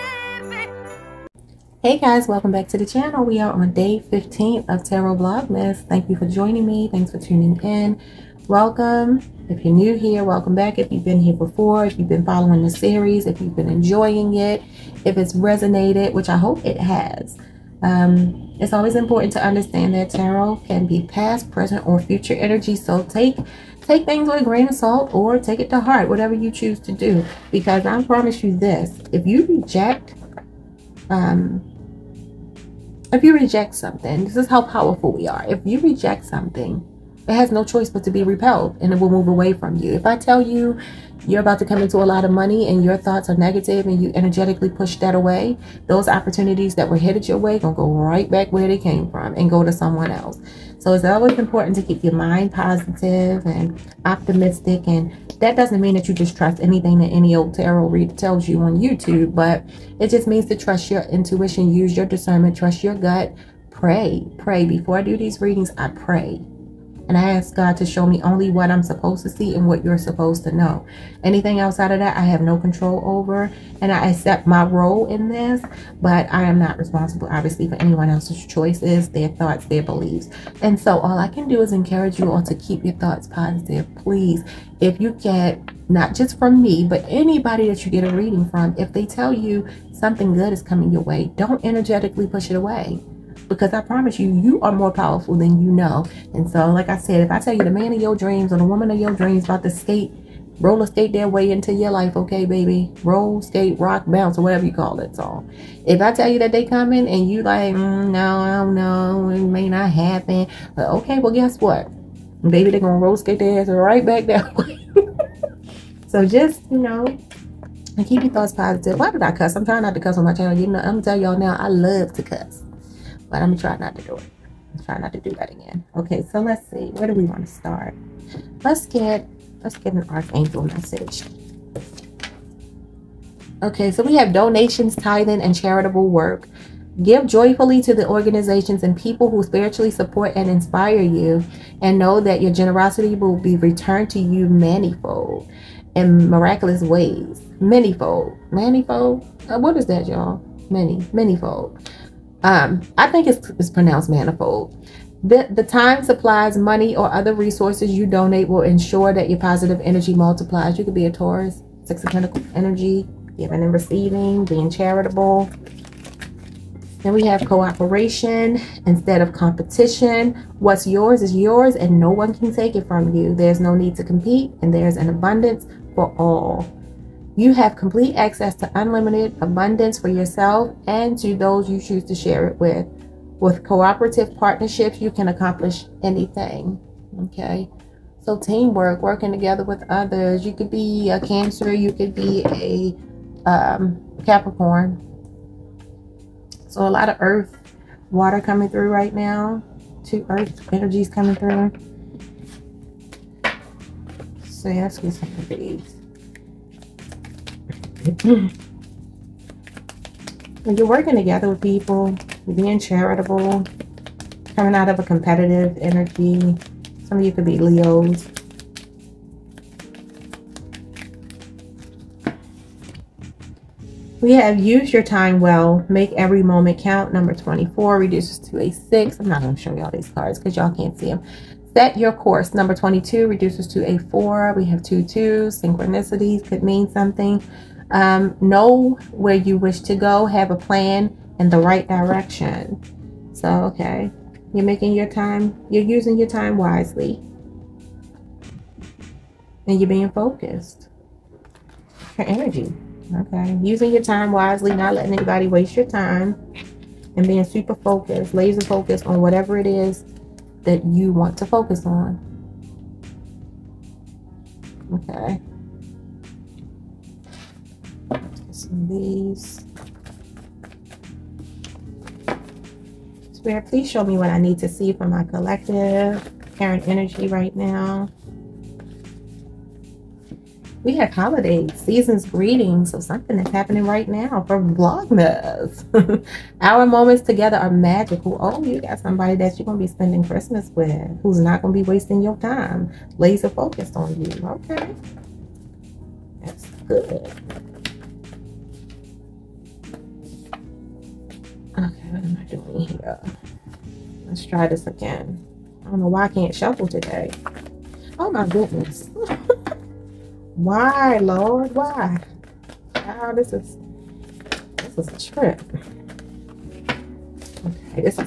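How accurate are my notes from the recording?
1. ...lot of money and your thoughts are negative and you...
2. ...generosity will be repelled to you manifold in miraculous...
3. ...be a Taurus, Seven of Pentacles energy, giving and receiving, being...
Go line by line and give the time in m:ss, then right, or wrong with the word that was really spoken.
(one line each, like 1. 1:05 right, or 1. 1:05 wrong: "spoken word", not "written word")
1. 0:42 right
2. 2:22 wrong: "returned", not "repelled"
3. 2:40 wrong: "Six", not "Seven".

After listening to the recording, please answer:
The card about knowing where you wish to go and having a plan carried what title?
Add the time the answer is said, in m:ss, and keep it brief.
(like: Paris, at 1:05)
Set your course, at 3:51.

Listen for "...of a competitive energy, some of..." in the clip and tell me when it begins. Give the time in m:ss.
3:34.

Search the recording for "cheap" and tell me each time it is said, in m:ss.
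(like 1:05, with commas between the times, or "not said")
not said.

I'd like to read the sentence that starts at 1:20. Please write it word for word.
And so all I can do is encourage you all to keep your thoughts positive.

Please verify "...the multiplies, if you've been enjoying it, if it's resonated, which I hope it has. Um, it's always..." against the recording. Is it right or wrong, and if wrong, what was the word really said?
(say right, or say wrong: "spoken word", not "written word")
wrong: "series", not "multiplies".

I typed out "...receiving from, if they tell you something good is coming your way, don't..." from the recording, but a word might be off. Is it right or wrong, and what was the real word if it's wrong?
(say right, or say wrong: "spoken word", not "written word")
wrong: "reading", not "receiving".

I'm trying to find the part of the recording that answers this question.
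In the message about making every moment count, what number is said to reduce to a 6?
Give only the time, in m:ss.
3:47.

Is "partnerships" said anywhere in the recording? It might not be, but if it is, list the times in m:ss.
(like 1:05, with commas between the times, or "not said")
3:04.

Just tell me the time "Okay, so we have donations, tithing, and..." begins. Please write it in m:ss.
2:13.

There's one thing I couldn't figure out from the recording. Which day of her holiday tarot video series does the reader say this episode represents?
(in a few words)
Day 15.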